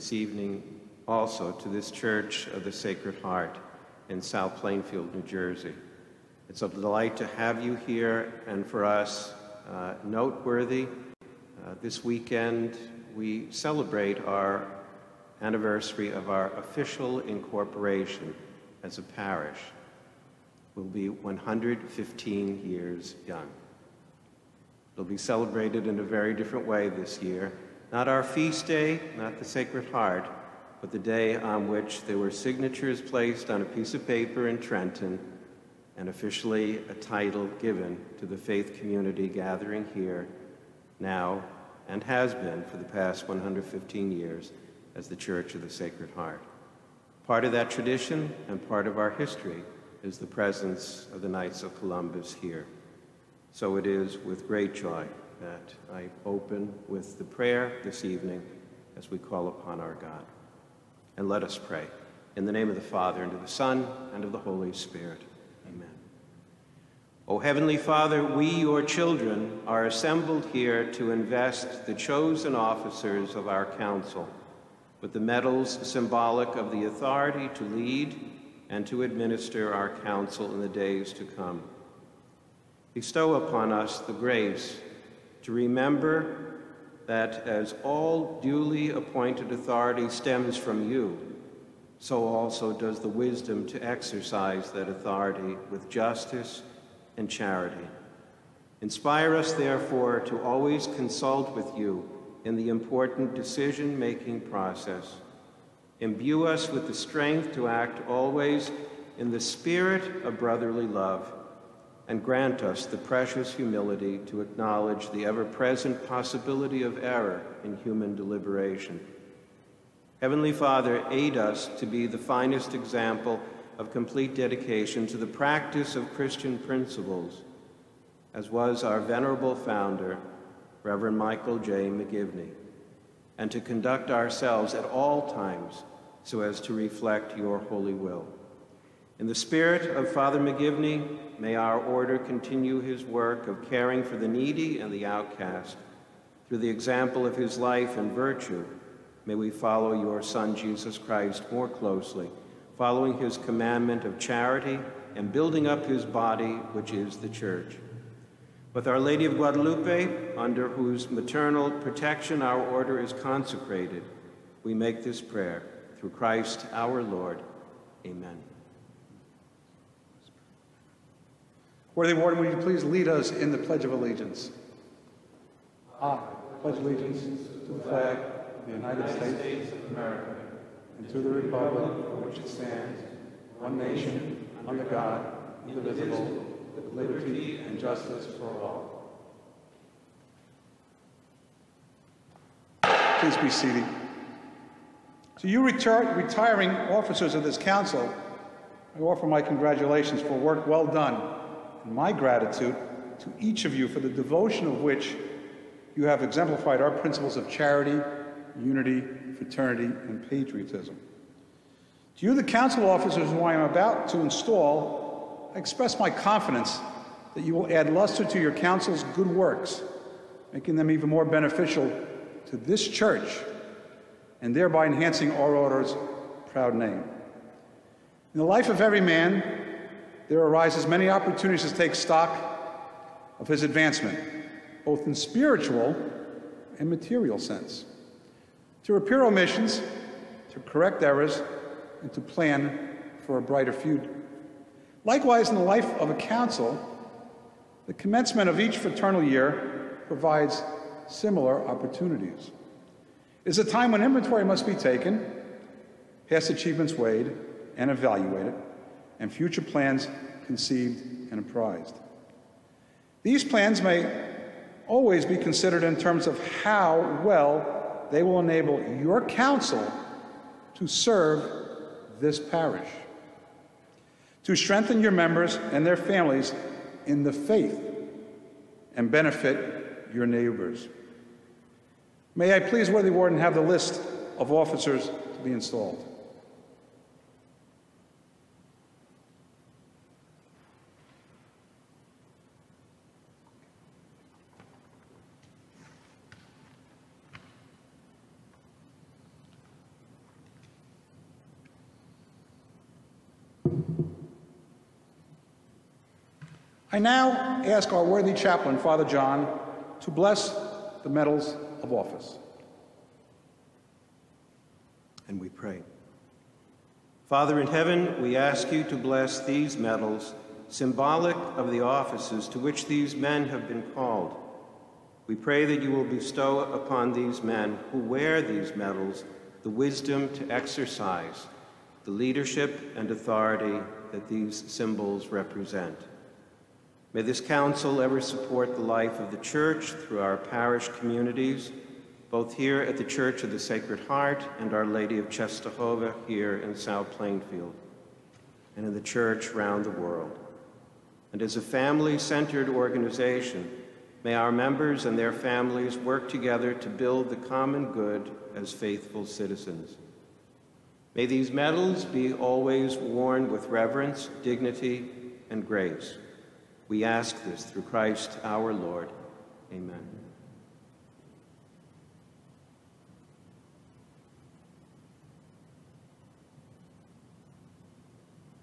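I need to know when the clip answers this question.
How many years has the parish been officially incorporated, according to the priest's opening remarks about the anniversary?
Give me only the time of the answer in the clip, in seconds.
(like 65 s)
21 s.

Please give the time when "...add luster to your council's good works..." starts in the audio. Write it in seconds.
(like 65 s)
217 s.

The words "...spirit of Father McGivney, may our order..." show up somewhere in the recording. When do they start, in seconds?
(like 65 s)
139 s.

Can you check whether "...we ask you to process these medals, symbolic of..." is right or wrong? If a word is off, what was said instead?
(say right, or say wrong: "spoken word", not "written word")
wrong: "bless", not "process".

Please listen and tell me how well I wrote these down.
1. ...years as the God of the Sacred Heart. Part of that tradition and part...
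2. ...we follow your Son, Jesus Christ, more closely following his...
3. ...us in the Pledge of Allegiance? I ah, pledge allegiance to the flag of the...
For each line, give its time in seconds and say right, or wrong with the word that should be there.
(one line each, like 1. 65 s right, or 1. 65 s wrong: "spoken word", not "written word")
1. 44 s wrong: "Church", not "God"
2. 149 s right
3. 173 s right.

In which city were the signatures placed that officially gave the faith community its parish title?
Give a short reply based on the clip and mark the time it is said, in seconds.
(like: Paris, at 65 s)
Trenton, at 34 s.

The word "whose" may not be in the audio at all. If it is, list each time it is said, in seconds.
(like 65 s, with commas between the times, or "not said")
160 s.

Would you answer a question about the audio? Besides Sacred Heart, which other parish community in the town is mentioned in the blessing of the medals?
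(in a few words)
Our Lady of Czestochowa.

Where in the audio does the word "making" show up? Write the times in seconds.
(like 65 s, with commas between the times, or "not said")
103 s, 220 s.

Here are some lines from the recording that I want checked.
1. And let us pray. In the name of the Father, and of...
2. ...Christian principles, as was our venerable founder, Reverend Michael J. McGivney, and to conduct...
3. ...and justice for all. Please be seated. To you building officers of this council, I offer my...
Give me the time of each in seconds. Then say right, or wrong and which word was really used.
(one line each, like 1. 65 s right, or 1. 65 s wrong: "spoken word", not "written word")
1. 61 s right
2. 126 s right
3. 187 s wrong: "retiring", not "building".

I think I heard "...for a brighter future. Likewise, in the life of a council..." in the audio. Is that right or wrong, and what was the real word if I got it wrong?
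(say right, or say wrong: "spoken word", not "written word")
right.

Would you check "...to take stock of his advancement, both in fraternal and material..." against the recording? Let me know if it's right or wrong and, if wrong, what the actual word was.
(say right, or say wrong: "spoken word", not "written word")
wrong: "spiritual", not "fraternal".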